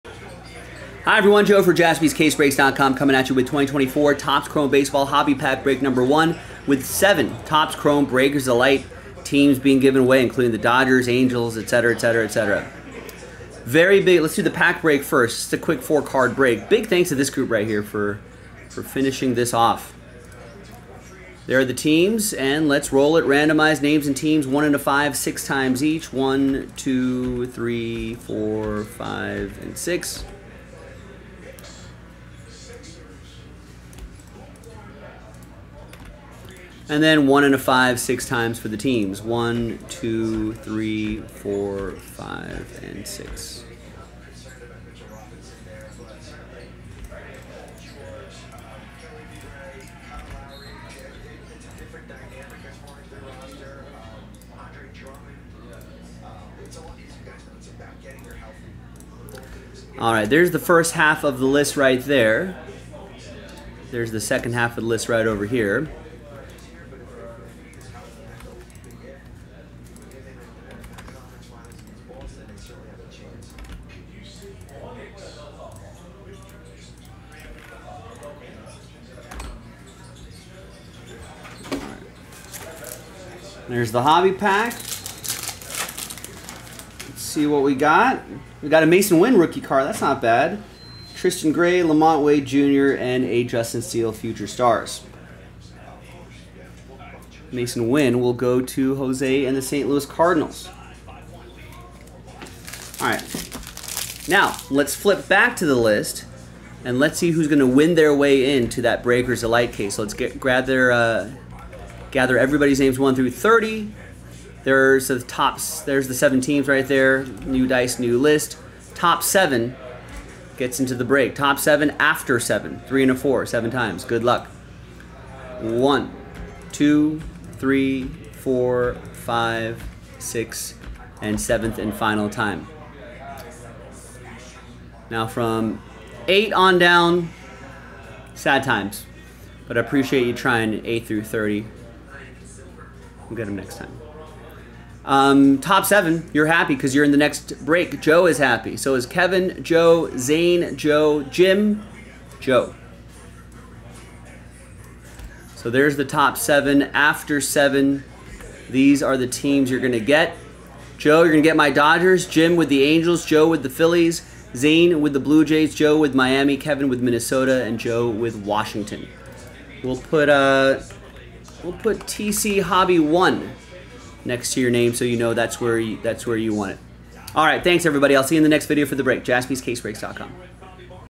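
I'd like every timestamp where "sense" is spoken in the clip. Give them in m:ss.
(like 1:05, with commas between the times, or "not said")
not said.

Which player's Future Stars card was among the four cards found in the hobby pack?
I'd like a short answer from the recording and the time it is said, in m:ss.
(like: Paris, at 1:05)
Justin Steele, at 1:33.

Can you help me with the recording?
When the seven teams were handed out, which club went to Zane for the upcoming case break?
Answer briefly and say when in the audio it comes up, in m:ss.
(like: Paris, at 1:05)
Blue Jays, at 2:45.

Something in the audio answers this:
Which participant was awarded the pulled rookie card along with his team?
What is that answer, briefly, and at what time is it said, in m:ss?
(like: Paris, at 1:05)
Jose, at 1:38.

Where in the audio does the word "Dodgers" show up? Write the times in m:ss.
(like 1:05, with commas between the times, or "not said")
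0:10, 2:41.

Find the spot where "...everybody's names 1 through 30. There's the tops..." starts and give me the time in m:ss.
1:52.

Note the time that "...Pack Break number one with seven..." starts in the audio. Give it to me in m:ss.
0:05.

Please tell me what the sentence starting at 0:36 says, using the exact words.
And then one and a five six times for the teams.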